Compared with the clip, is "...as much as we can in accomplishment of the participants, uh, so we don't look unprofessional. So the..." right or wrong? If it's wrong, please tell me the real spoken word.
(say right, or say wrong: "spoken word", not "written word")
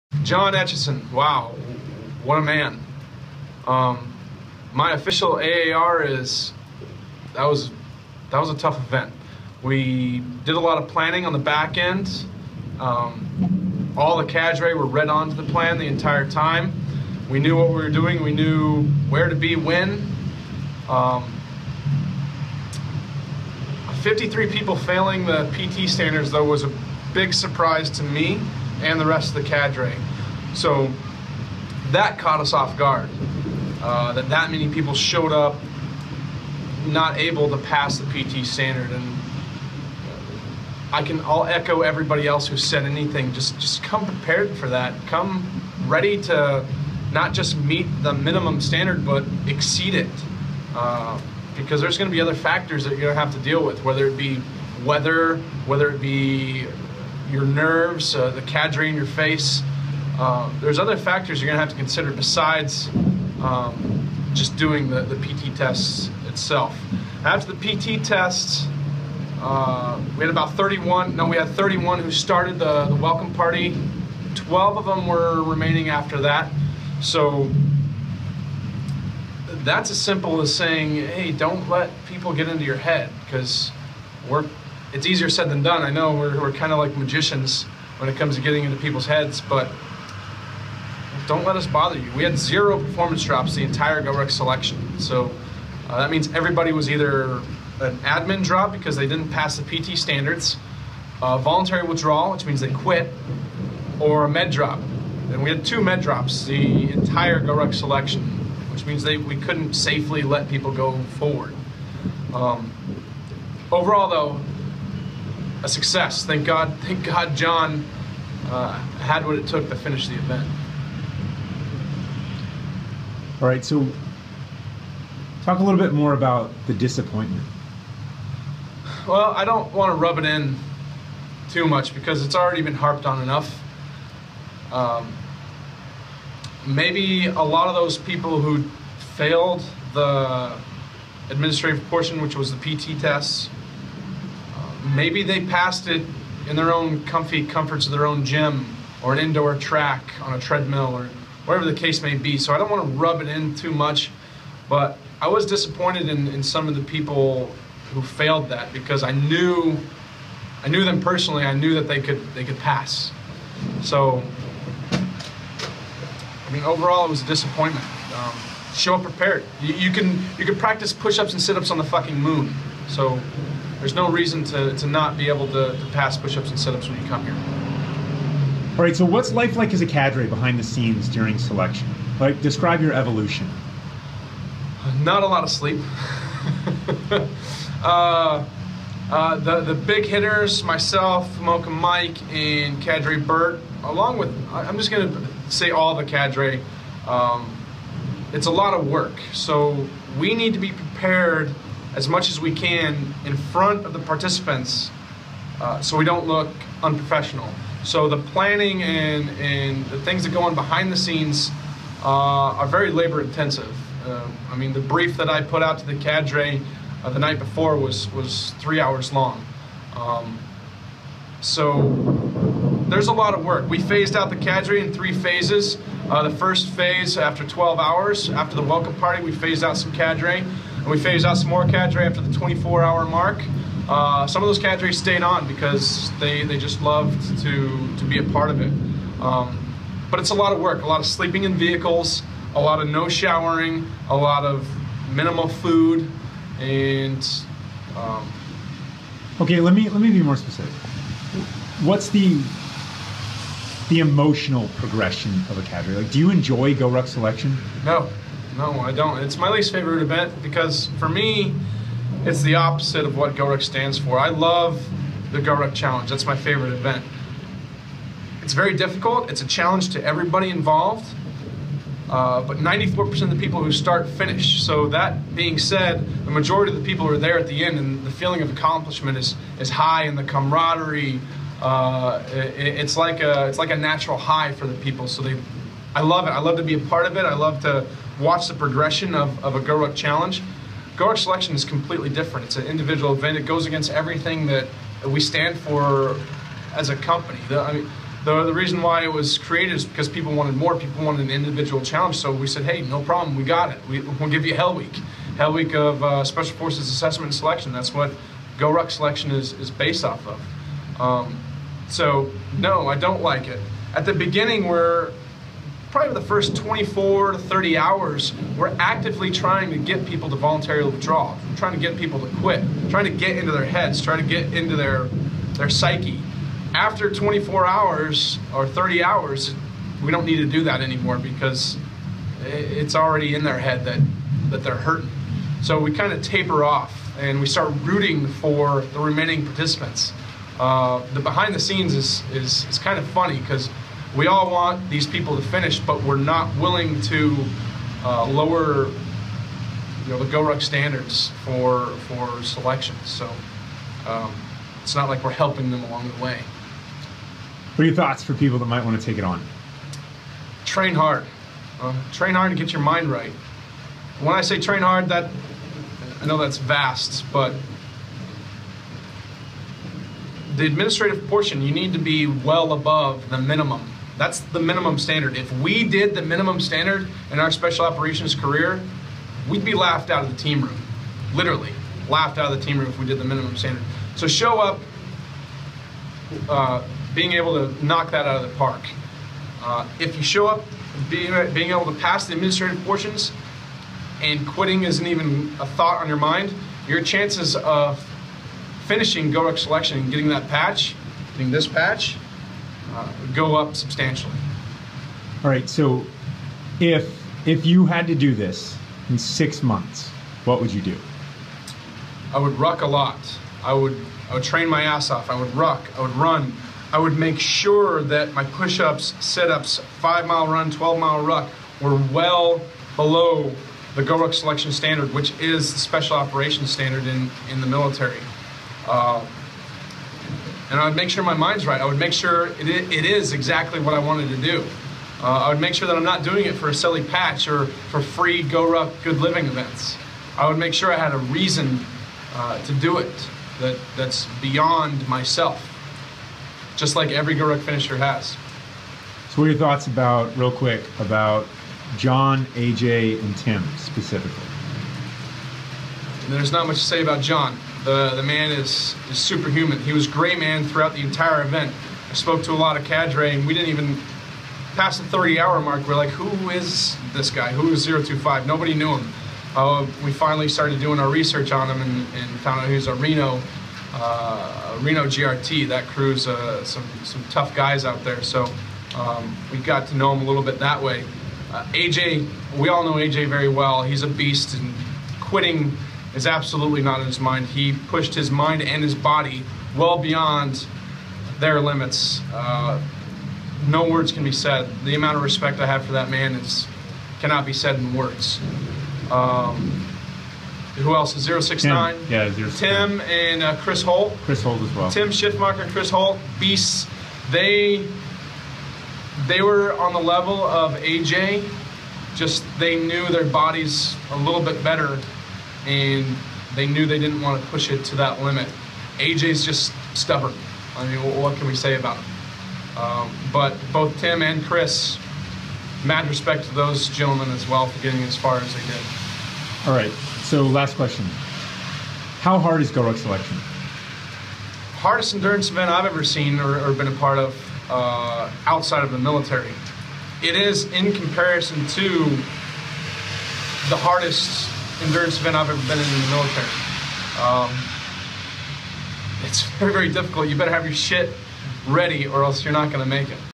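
wrong: "front", not "accomplishment".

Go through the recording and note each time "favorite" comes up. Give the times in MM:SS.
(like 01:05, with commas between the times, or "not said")
04:19, 04:26.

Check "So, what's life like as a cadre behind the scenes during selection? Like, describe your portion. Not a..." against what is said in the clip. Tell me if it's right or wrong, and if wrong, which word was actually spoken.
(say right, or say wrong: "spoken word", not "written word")
wrong: "evolution", not "portion".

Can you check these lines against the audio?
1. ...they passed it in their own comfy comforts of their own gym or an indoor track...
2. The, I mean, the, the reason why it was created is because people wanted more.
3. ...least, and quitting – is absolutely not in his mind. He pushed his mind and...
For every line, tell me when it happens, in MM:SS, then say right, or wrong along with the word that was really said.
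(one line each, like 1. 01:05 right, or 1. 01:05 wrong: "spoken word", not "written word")
1. 02:25 right
2. 04:57 right
3. 08:04 wrong: "beast", not "least".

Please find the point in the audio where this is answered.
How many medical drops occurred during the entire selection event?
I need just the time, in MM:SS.
01:45.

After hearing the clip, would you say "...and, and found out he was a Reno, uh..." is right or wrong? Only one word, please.
right.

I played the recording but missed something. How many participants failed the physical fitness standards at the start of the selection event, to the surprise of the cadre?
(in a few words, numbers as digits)
53.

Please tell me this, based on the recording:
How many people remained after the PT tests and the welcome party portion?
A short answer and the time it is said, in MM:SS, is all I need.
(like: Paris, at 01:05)
12, at 01:14.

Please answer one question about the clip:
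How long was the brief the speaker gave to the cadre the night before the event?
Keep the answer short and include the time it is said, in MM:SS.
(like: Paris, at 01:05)
Three hours, at 03:38.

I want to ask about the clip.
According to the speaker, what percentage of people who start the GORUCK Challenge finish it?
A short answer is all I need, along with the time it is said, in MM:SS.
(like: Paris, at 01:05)
94%, at 04:32.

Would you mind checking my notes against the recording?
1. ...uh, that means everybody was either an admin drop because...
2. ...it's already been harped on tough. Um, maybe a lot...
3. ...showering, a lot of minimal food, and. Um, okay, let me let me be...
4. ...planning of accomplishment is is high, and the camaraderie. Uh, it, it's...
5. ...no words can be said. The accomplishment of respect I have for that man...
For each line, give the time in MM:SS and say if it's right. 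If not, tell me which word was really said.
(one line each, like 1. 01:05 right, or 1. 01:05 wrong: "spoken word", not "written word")
1. 01:35 right
2. 02:12 wrong: "enough", not "tough"
3. 04:03 right
4. 04:38 wrong: "feeling", not "planning"
5. 08:13 wrong: "amount", not "accomplishment".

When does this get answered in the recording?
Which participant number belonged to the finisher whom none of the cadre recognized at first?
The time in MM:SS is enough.
07:47.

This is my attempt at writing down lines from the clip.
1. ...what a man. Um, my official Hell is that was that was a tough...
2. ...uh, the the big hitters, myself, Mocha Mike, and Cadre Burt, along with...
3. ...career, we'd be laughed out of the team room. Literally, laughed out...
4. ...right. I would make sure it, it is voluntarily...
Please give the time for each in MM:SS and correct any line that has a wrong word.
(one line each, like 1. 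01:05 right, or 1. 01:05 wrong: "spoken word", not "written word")
1. 00:02 wrong: "AAR", not "Hell"
2. 03:09 right
3. 06:18 right
4. 07:11 wrong: "exactly", not "voluntarily".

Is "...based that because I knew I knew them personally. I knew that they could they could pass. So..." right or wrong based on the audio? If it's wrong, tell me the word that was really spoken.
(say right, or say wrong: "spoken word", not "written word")
wrong: "failed", not "based".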